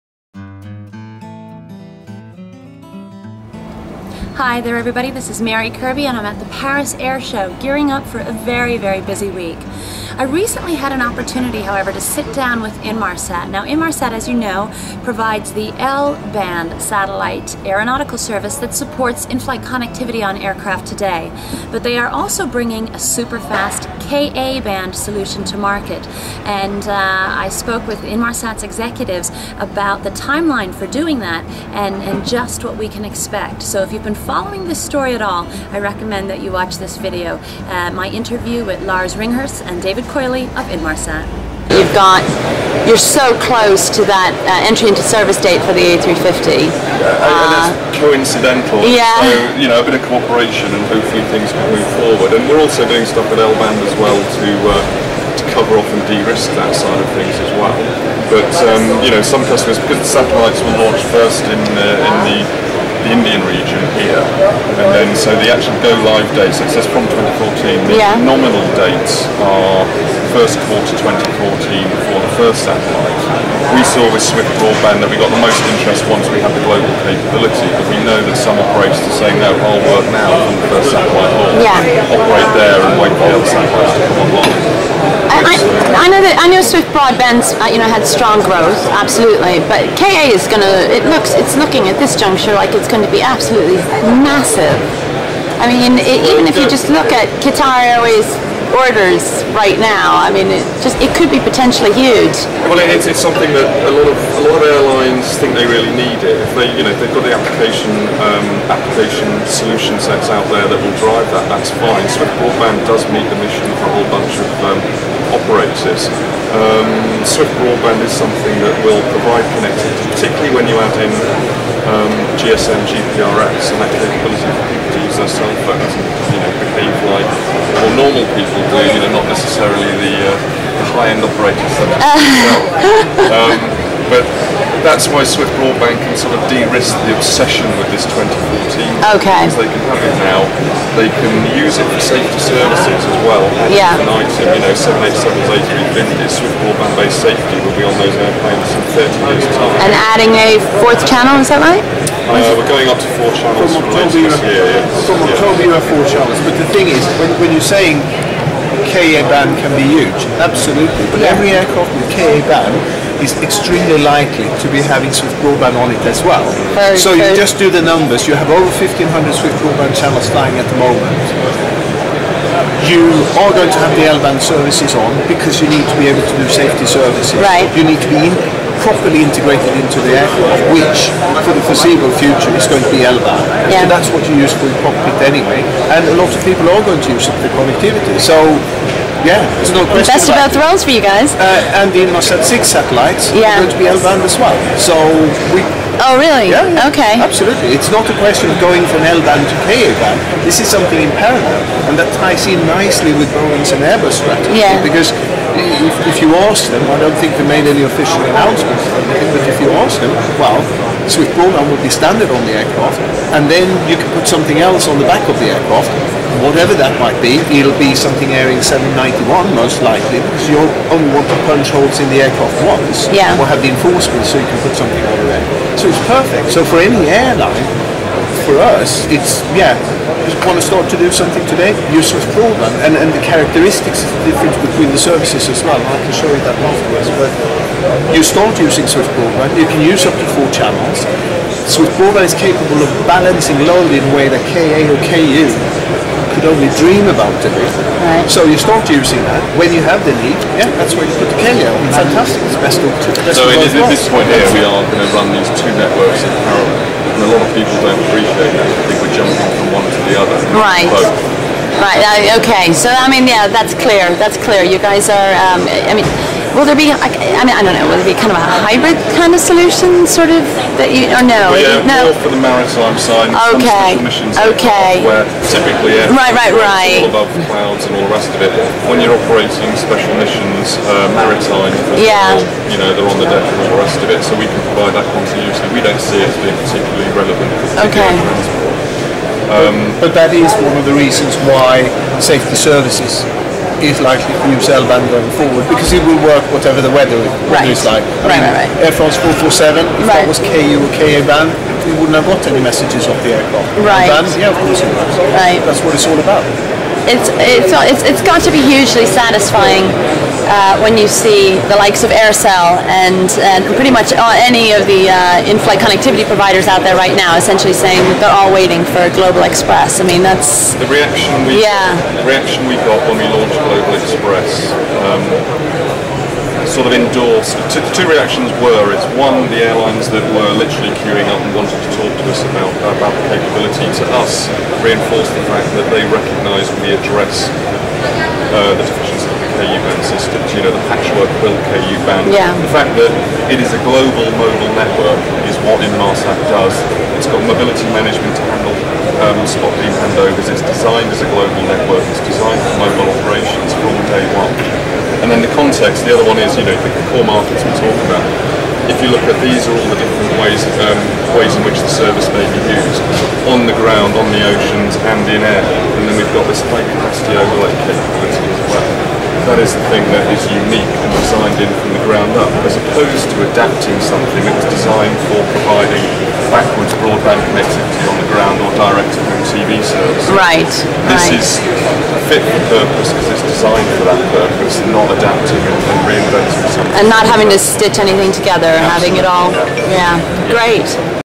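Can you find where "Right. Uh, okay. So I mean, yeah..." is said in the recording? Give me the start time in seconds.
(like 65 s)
261 s.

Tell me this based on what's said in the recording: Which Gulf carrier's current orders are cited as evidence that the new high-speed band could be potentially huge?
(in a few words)
Qatar Airways.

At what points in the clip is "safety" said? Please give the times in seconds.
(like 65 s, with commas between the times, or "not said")
142 s, 147 s, 176 s, 292 s.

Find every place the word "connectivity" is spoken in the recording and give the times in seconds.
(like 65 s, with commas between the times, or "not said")
19 s, 119 s, 187 s, 315 s, 377 s.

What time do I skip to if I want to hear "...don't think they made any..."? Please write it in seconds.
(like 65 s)
206 s.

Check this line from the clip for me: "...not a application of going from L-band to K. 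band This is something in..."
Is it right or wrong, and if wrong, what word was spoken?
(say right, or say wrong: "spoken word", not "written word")
wrong: "question", not "application".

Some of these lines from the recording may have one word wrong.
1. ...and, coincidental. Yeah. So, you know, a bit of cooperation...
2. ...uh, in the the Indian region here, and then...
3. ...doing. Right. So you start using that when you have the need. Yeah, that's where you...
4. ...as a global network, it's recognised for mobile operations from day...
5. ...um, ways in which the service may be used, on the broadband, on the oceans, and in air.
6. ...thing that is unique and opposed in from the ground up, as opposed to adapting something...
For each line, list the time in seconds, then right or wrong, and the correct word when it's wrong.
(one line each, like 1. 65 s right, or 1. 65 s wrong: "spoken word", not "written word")
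1. 47 s right
2. 61 s right
3. 247 s right
4. 351 s wrong: "designed", not "recognised"
5. 360 s wrong: "ground", not "broadband"
6. 369 s wrong: "designed", not "opposed".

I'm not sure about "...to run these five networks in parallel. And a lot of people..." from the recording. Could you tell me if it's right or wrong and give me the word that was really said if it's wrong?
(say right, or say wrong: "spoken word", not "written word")
wrong: "two", not "five".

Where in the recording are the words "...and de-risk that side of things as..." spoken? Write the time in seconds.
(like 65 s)
55 s.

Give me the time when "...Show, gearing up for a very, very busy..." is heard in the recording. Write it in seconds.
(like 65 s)
7 s.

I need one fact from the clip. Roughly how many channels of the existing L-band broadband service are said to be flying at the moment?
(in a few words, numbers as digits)
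1,500.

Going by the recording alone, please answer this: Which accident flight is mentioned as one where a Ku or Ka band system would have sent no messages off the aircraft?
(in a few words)
Air France 447.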